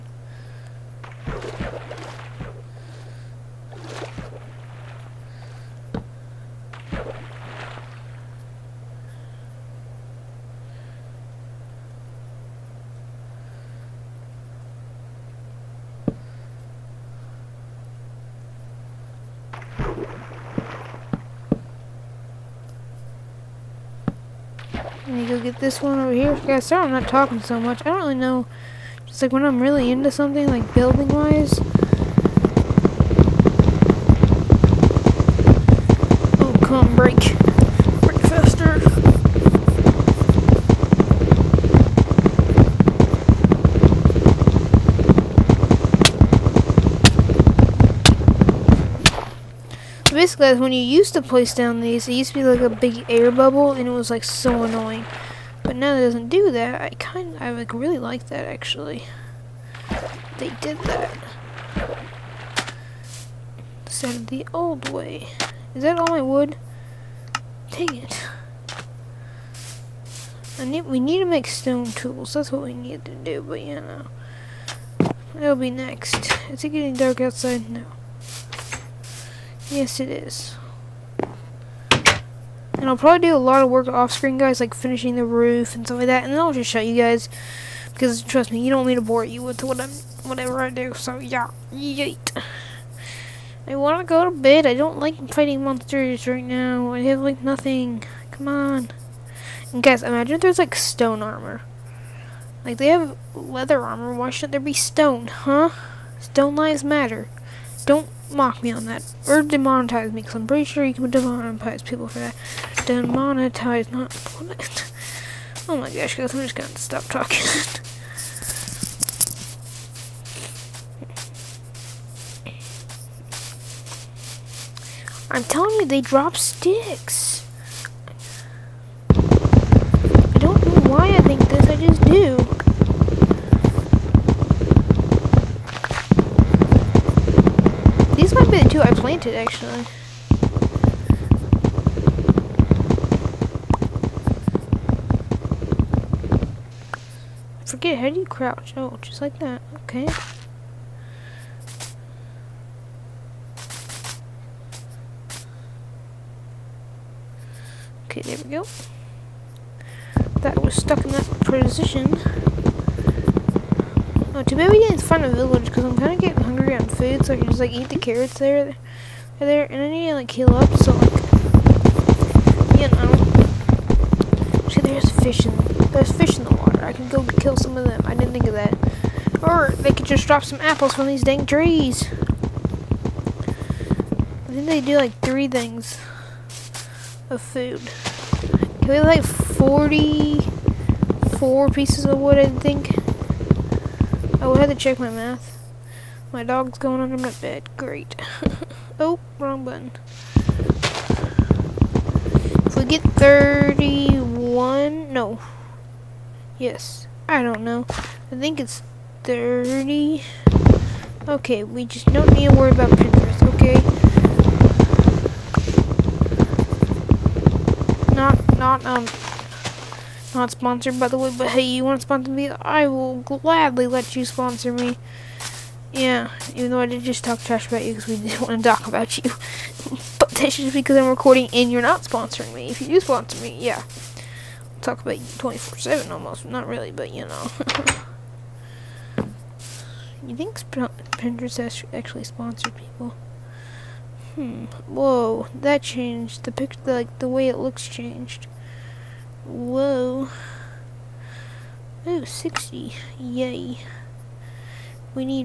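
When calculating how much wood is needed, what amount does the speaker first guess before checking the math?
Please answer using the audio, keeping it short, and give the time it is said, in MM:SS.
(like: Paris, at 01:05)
44, at 03:09.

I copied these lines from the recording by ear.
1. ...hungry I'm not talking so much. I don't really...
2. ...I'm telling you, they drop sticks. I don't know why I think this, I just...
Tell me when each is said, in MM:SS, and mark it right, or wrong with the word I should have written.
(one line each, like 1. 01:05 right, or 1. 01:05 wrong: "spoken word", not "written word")
1. 00:26 wrong: "sorry", not "hungry"
2. 02:05 right.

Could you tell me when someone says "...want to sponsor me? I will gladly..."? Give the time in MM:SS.
03:41.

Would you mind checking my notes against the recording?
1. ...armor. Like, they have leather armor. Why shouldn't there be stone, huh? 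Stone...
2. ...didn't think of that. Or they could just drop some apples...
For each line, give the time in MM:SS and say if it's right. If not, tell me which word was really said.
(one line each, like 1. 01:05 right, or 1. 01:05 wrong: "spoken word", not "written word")
1. 01:41 right
2. 02:58 right.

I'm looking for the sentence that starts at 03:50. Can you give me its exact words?
but that's just because I'm recording and you're not sponsoring me.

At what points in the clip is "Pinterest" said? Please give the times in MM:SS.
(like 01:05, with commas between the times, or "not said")
03:32, 04:01.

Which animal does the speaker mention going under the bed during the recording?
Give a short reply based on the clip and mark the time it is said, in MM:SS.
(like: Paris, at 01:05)
dog, at 03:16.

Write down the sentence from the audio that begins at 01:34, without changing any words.
I don't like fighting monsters right now.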